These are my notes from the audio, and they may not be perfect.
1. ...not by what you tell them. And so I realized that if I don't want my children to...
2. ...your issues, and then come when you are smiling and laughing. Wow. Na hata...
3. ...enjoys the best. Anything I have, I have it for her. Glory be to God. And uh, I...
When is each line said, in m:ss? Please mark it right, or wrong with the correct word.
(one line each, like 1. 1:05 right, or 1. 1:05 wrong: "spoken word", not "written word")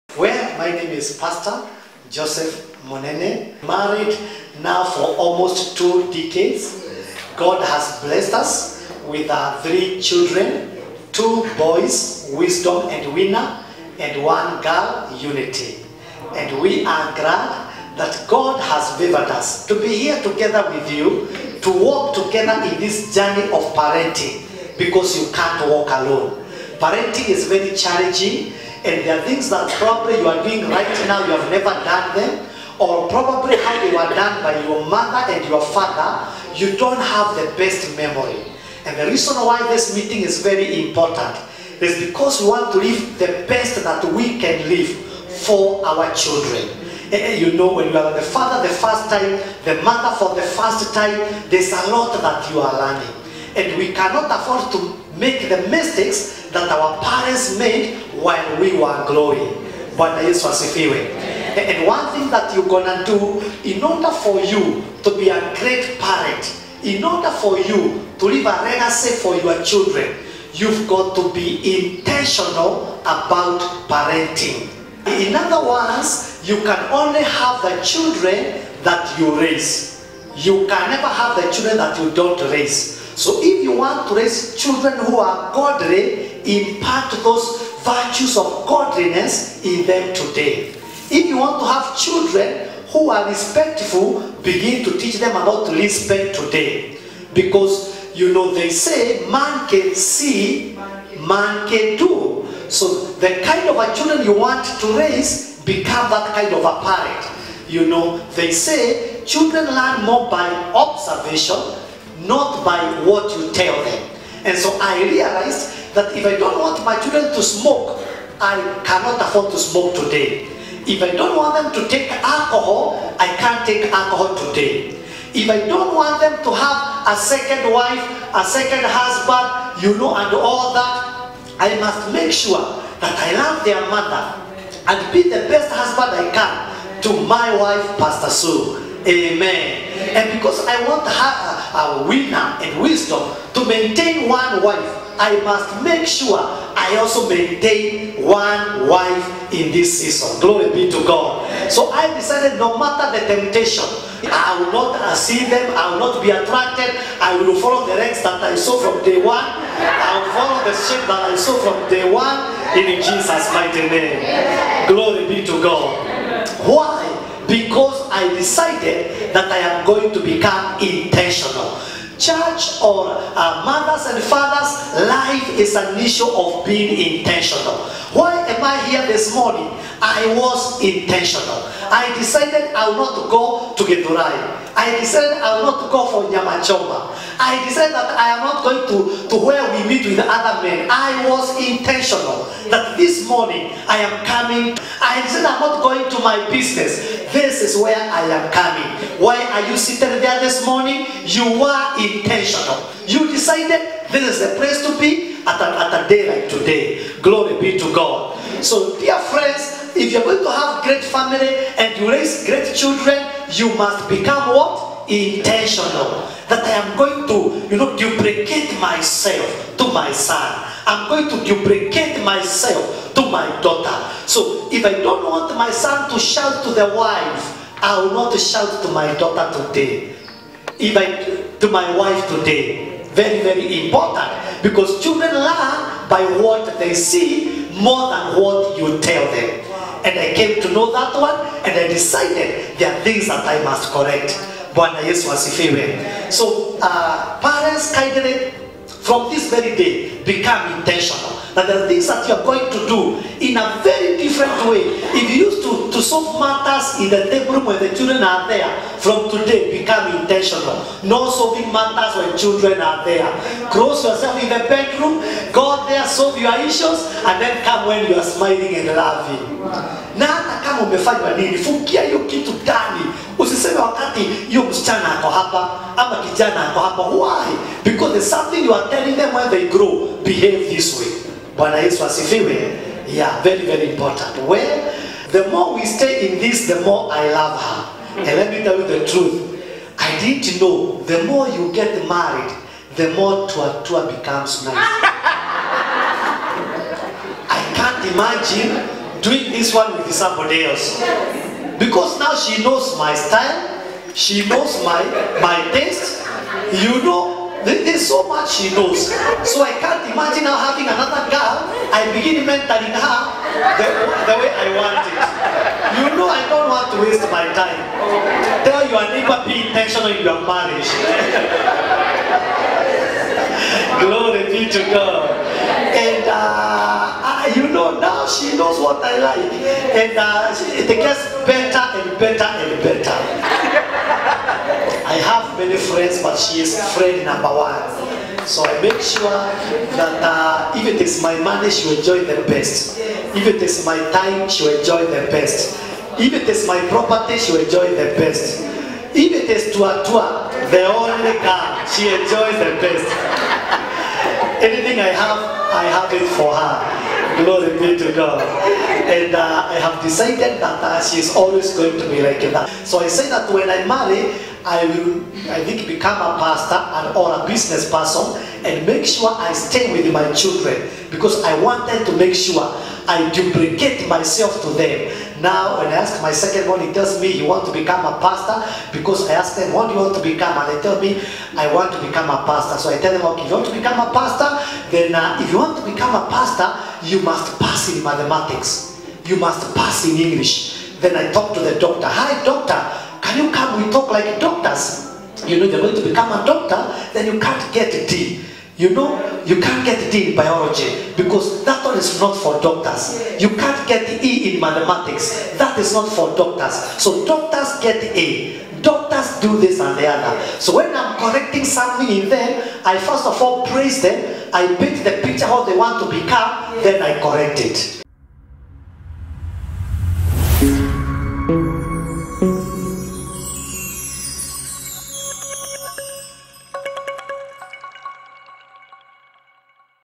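1. 1:52 right
2. 4:26 right
3. 5:52 right.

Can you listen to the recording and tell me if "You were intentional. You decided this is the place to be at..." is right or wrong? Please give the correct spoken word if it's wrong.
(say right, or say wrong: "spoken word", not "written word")
right.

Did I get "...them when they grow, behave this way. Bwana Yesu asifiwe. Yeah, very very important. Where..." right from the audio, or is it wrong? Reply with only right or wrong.
right.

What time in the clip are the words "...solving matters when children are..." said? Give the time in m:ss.
4:21.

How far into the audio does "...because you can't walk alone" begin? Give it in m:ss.
0:24.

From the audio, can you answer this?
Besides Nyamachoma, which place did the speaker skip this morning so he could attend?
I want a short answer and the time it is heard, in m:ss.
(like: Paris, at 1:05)
Gedurai, at 3:03.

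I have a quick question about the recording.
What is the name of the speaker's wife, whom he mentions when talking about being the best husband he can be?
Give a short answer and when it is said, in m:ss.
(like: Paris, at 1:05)
Pastor Sue, at 2:17.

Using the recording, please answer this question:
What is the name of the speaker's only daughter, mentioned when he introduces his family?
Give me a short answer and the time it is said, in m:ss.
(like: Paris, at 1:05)
Unity, at 0:15.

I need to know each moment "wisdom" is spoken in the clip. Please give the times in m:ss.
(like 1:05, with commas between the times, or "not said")
0:12, 2:22.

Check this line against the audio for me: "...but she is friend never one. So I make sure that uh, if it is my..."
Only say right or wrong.
wrong.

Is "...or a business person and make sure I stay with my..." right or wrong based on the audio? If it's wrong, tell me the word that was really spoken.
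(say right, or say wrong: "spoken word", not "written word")
right.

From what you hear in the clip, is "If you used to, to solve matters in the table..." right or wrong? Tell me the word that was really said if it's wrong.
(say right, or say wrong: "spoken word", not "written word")
right.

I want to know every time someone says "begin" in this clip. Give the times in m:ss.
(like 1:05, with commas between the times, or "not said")
1:34, 5:12.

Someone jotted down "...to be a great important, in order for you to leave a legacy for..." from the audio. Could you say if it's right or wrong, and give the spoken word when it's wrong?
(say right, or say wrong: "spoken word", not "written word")
wrong: "parent", not "important".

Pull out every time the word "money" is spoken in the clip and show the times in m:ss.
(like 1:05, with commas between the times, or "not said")
5:41.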